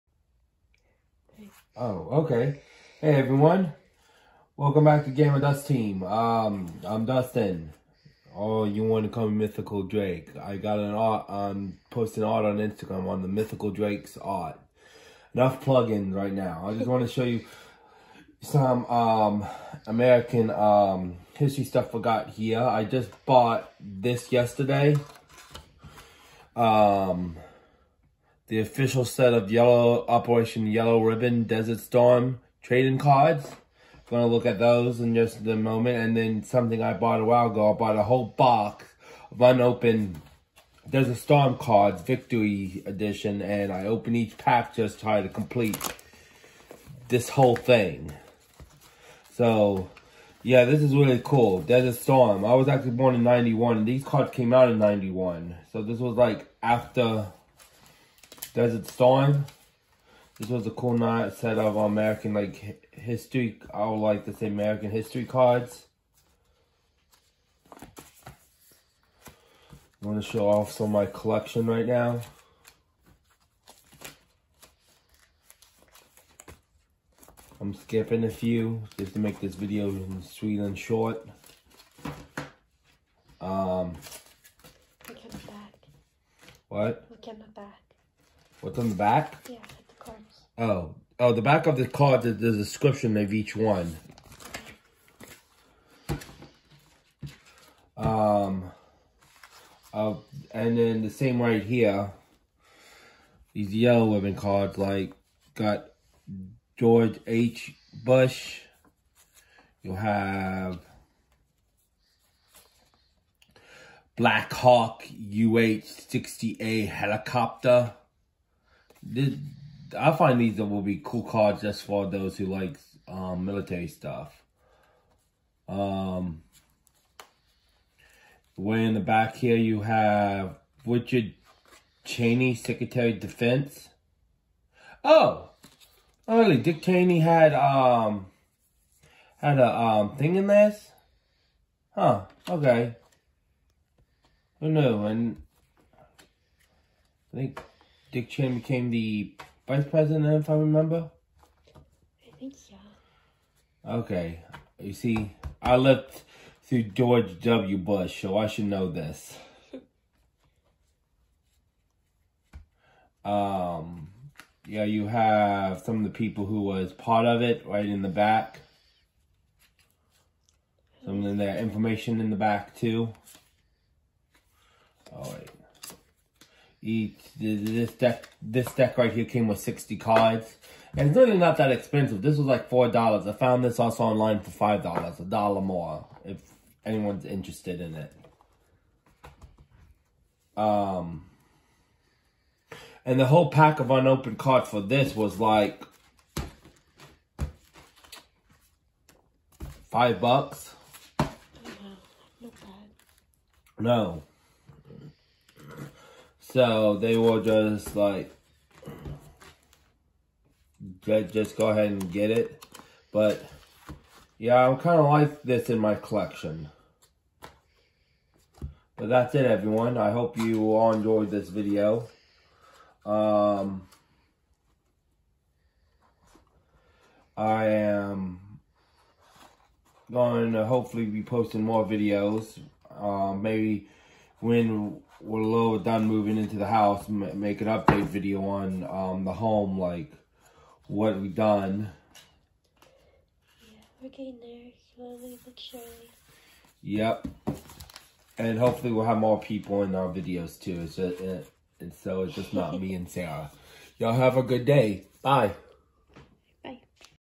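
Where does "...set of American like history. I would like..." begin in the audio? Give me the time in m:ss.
1:01.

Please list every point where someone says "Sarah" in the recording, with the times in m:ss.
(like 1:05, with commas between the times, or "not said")
4:13.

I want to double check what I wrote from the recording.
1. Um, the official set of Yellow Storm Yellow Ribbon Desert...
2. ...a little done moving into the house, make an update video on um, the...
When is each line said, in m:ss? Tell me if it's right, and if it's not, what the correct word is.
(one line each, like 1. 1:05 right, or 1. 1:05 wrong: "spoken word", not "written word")
1. 0:26 wrong: "Operation", not "Storm"
2. 3:55 right.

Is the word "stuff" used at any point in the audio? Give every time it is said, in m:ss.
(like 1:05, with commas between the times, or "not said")
0:21, 2:03.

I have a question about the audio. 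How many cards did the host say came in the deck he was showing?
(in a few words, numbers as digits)
60.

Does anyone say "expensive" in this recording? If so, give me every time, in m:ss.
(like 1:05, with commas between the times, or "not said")
3:01.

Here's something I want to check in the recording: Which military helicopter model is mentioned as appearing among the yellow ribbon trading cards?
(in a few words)
Black Hawk UH-60A.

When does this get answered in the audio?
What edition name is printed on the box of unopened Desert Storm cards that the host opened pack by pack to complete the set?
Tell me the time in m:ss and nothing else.
0:42.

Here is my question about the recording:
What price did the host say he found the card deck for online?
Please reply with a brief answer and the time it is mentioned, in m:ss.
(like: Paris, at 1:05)
$5, at 3:04.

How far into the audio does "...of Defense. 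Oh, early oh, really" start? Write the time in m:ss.
2:13.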